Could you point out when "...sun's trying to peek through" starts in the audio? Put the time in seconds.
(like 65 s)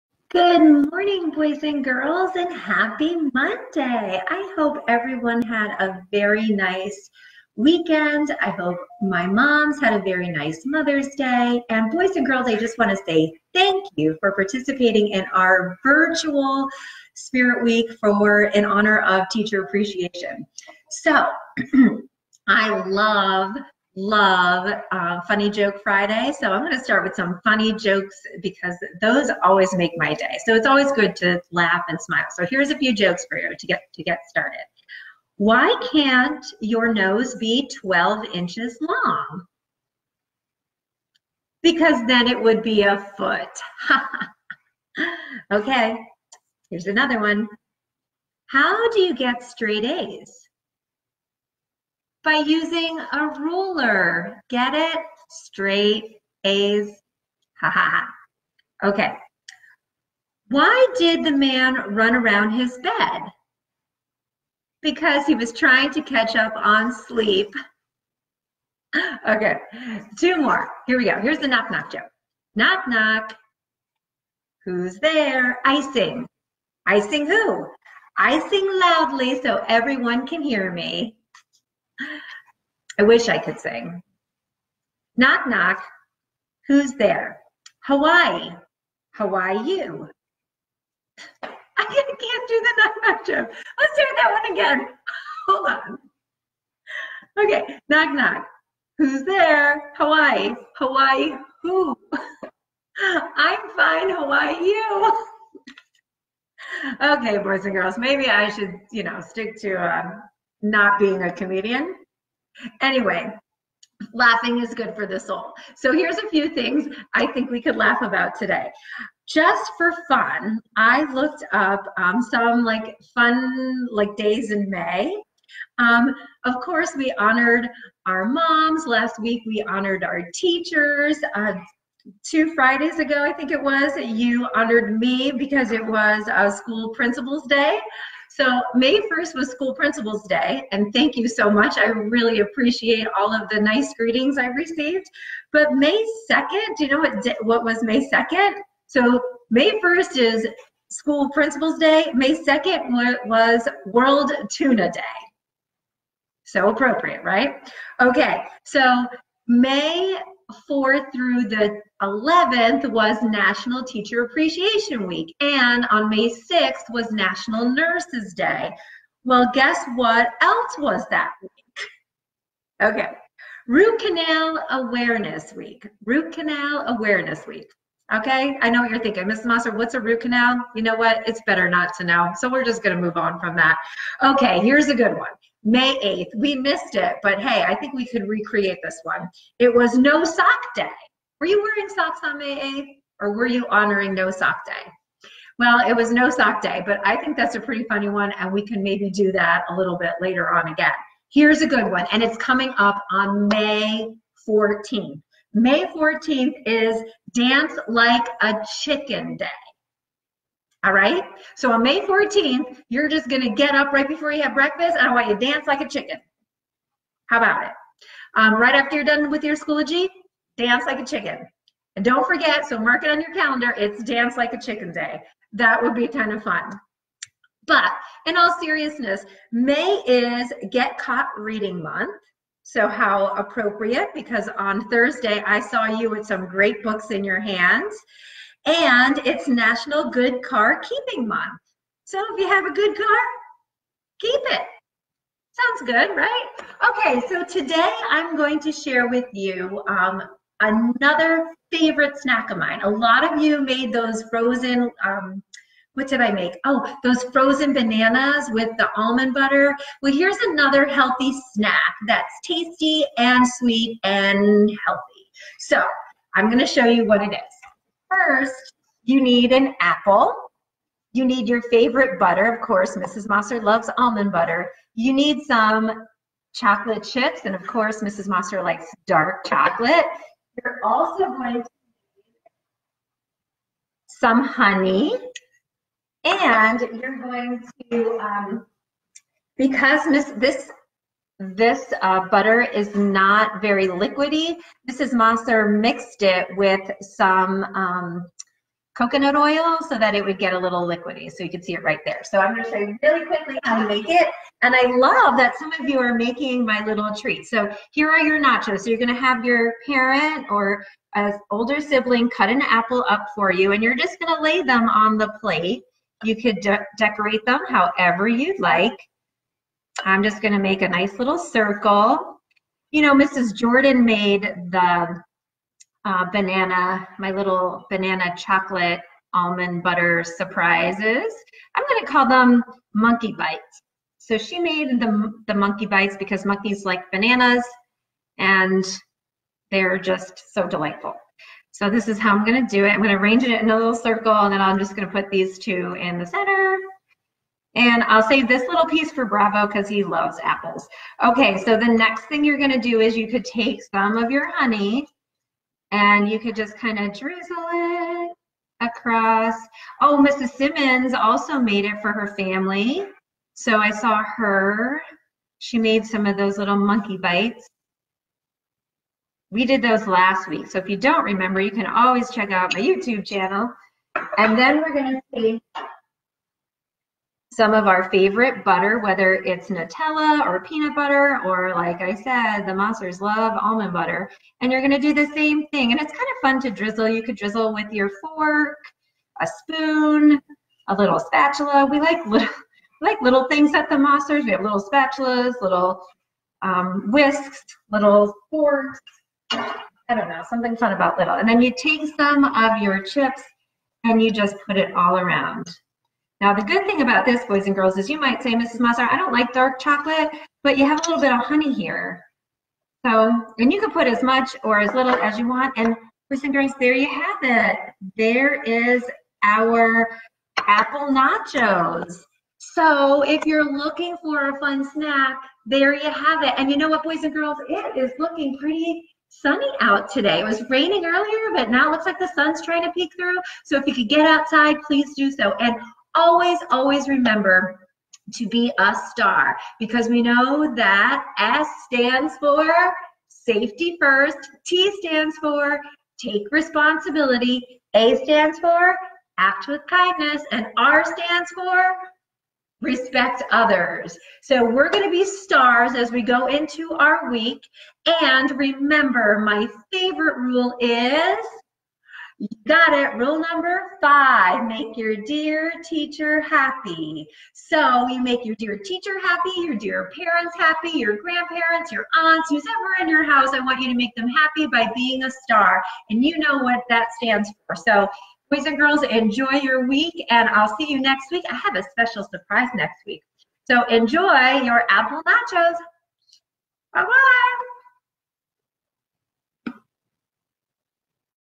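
432 s.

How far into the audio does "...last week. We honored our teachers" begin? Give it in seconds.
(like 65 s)
128 s.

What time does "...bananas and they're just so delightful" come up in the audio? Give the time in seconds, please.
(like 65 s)
337 s.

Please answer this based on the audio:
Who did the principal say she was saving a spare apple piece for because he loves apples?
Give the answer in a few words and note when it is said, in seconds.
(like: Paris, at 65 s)
Bravo, at 349 s.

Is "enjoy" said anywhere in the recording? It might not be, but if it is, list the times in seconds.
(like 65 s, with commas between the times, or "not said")
479 s, 483 s.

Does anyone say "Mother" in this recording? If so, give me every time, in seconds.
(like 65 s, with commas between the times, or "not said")
10 s.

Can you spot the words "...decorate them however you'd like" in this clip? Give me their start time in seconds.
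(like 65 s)
316 s.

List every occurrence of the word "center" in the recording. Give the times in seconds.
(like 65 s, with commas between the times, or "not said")
346 s.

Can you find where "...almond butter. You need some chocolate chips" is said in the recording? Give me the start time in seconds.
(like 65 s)
273 s.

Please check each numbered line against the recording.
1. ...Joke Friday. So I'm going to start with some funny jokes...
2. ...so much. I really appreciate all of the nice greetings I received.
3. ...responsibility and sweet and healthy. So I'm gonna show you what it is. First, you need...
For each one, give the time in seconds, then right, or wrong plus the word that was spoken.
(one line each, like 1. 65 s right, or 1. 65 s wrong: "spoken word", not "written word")
1. 25 s right
2. 141 s right
3. 262 s wrong: "tasty", not "responsibility".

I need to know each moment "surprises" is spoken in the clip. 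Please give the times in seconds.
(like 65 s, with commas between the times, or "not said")
330 s, 482 s.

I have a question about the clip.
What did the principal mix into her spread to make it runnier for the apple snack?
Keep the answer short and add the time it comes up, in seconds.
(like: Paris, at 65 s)
Coconut oil, at 298 s.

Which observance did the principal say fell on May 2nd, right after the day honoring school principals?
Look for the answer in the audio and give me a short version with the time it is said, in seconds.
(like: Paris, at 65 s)
World Tuna Day, at 153 s.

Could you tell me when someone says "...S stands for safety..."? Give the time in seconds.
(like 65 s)
441 s.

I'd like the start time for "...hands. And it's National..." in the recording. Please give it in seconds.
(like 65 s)
237 s.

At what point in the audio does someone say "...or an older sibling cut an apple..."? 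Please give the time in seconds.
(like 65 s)
310 s.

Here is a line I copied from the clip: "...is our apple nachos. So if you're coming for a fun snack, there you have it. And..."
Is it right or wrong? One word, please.
wrong.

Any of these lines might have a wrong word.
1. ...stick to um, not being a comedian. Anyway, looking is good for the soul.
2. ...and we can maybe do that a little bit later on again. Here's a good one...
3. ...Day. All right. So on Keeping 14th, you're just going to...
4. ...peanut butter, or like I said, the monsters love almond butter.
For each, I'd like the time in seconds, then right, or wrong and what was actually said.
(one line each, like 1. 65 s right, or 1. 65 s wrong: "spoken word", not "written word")
1. 109 s wrong: "laughing", not "looking"
2. 198 s right
3. 209 s wrong: "May", not "Keeping"
4. 380 s right.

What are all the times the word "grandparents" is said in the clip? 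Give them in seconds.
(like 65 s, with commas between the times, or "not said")
471 s.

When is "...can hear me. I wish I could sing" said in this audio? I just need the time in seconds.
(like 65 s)
80 s.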